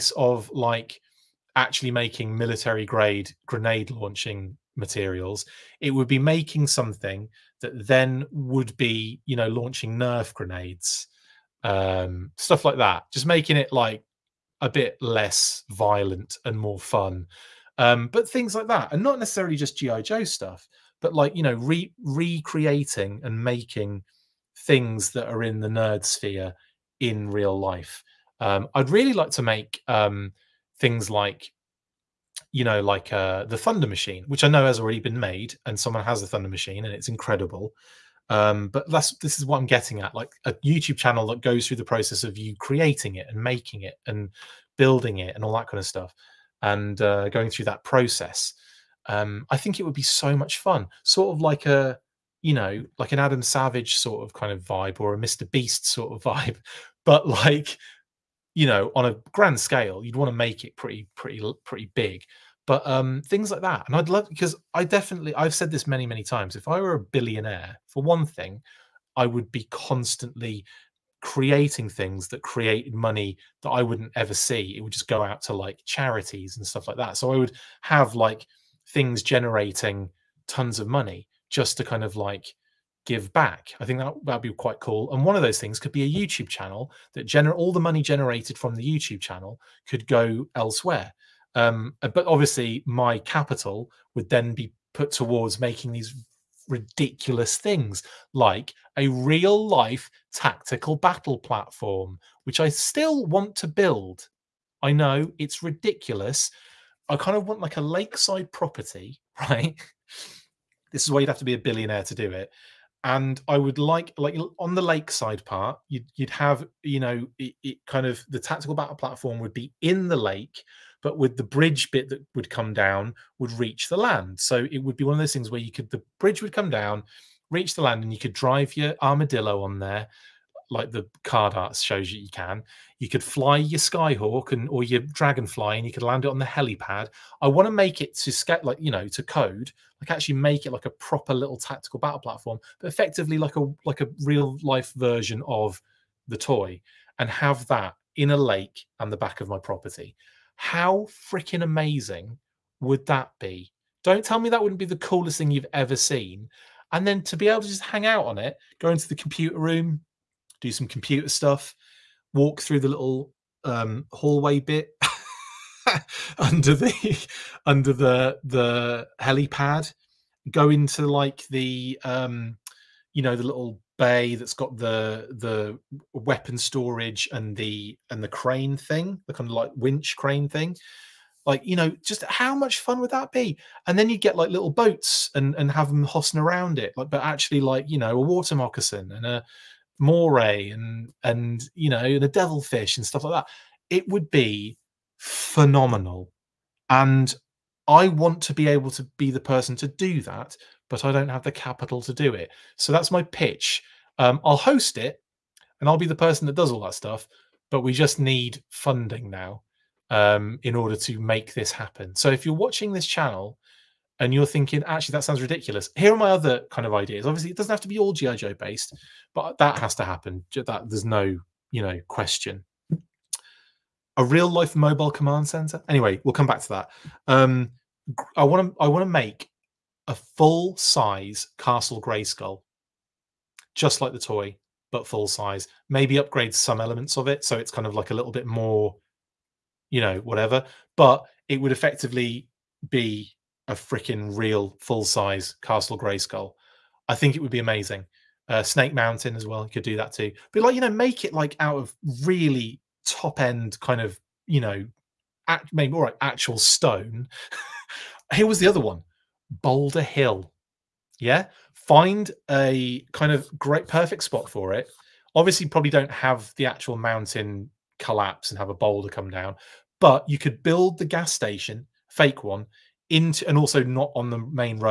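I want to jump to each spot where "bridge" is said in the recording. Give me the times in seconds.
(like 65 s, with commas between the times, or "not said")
121 s, 126 s.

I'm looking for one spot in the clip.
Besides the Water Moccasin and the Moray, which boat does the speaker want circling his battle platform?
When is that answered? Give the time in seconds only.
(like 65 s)
192 s.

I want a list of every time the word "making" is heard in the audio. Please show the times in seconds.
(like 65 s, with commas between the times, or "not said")
1 s, 6 s, 13 s, 23 s, 43 s, 95 s.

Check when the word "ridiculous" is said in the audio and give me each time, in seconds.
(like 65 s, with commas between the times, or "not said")
96 s, 105 s, 215 s.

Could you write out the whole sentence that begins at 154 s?
Don't tell me that wouldn't be the coolest thing you've ever seen.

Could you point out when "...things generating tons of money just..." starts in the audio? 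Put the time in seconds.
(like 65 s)
78 s.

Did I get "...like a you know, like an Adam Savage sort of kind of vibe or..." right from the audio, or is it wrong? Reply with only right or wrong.
right.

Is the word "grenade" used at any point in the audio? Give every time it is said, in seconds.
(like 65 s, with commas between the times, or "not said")
3 s, 10 s.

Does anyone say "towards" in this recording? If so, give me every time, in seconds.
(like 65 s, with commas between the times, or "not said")
95 s.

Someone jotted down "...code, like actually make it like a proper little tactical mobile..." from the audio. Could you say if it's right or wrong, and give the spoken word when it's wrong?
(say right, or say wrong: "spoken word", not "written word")
wrong: "battle", not "mobile".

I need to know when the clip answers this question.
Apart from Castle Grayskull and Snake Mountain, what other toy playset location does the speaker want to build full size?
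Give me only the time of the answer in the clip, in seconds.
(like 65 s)
259 s.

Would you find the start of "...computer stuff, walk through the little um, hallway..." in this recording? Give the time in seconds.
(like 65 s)
160 s.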